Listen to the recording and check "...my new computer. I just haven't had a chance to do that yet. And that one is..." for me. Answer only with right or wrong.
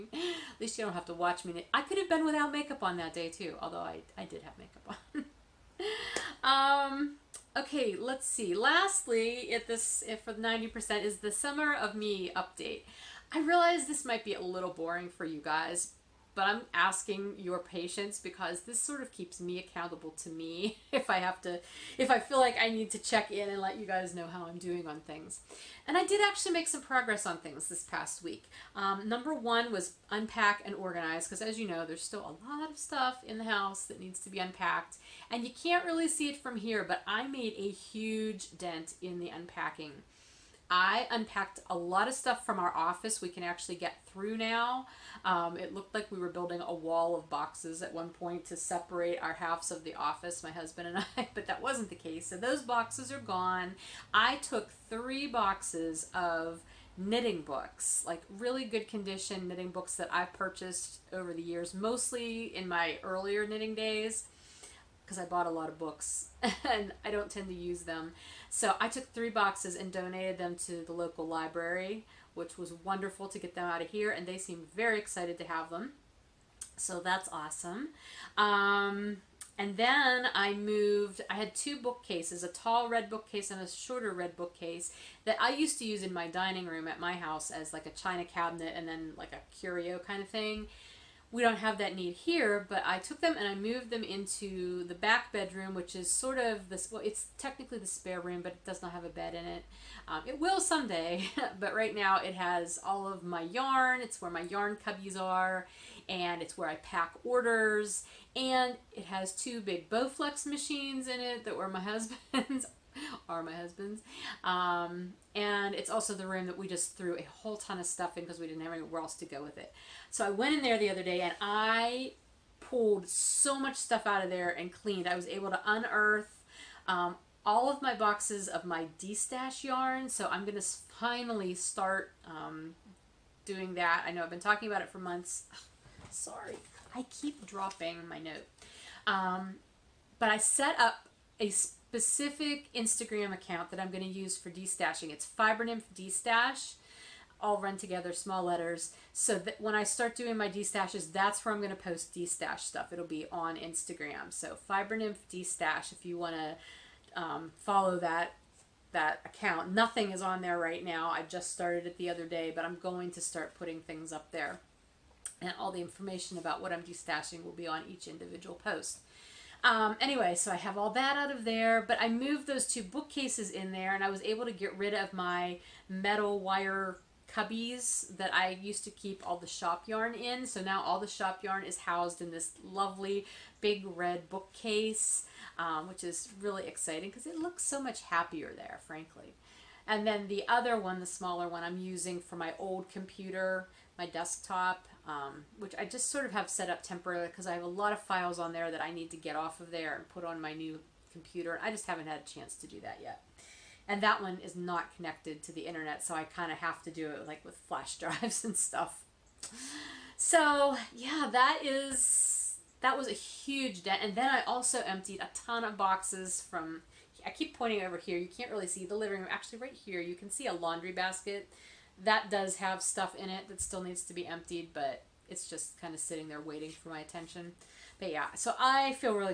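right.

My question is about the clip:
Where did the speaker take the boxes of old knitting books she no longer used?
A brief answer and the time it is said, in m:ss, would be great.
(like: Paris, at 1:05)
local library, at 1:10.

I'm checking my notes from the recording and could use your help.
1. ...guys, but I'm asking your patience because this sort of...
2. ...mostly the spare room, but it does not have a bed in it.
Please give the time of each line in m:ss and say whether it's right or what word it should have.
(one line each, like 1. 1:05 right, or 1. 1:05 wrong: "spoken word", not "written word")
1. 0:15 right
2. 1:37 wrong: "technically", not "mostly".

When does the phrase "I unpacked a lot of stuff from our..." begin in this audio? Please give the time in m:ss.
0:40.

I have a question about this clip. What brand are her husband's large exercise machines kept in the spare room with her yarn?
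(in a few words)
Bowflex.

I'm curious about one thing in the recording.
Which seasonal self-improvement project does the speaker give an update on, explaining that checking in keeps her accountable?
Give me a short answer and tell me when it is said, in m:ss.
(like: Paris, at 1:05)
summer of me, at 0:11.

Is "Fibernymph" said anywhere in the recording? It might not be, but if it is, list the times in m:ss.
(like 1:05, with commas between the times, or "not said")
2:25, 2:34.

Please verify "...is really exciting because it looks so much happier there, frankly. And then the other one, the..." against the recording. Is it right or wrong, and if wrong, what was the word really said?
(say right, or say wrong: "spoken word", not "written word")
right.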